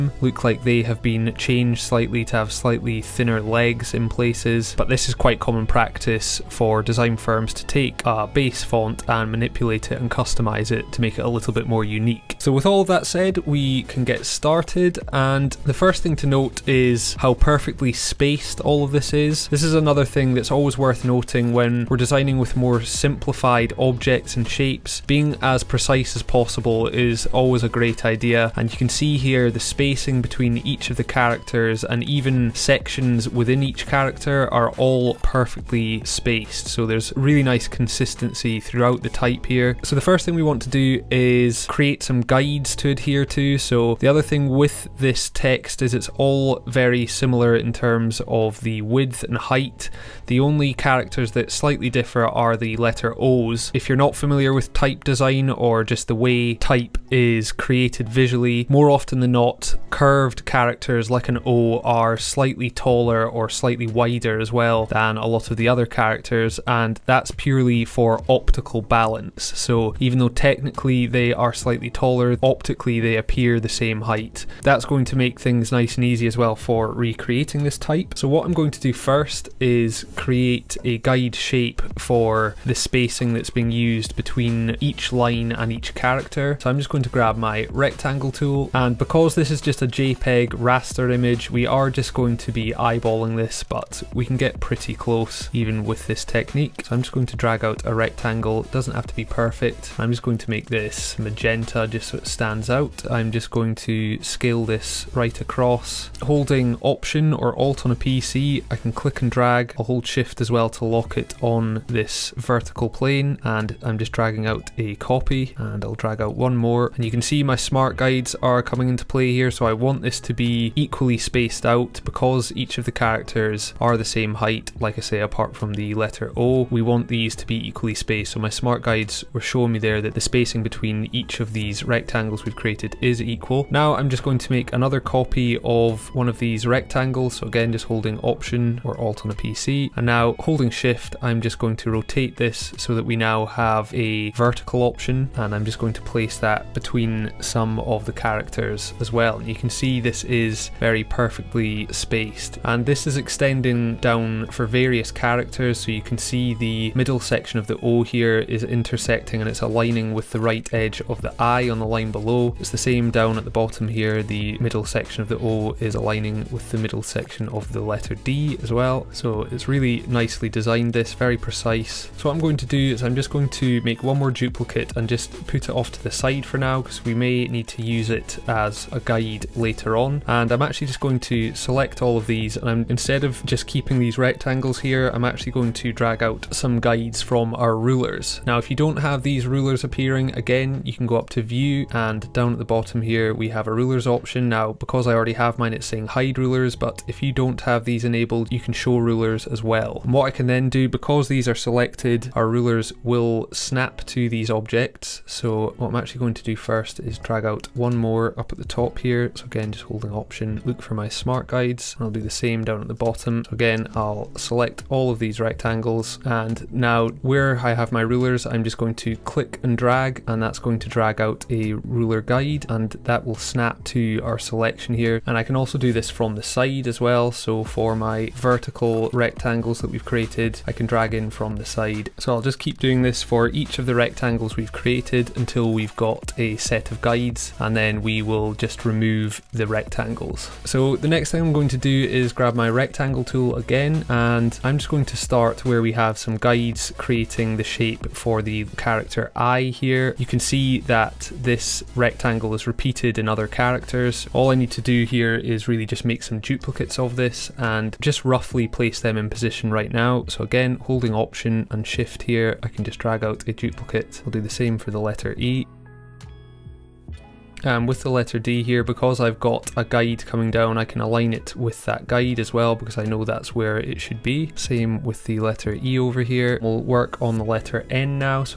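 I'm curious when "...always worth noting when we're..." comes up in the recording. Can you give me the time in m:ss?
0:20.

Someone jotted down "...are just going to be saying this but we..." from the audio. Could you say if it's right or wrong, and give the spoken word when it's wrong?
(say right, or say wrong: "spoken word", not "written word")
wrong: "eyeballing", not "saying".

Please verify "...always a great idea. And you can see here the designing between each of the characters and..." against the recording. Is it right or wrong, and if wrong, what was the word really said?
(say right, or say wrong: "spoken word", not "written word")
wrong: "spacing", not "designing".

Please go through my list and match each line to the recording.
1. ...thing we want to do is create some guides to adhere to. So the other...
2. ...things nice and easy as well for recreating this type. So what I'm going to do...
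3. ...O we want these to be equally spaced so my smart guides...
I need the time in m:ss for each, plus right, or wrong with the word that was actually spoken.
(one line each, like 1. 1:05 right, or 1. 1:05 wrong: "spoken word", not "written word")
1. 0:40 right
2. 1:15 right
3. 2:06 right.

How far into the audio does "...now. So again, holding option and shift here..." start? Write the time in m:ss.
4:19.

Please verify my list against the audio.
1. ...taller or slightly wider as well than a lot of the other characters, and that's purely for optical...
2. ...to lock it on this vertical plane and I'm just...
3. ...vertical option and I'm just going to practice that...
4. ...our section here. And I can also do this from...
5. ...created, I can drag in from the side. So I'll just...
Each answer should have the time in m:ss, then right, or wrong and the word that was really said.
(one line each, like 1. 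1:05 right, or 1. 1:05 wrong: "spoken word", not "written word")
1. 1:02 right
2. 1:50 right
3. 2:24 wrong: "place", not "practice"
4. 3:44 wrong: "selection", not "section"
5. 3:50 right.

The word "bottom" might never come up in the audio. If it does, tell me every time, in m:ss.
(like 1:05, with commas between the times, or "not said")
2:43, 3:12, 3:32.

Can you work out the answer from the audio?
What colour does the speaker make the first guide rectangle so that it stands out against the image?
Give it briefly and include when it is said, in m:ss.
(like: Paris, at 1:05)
Magenta, at 1:41.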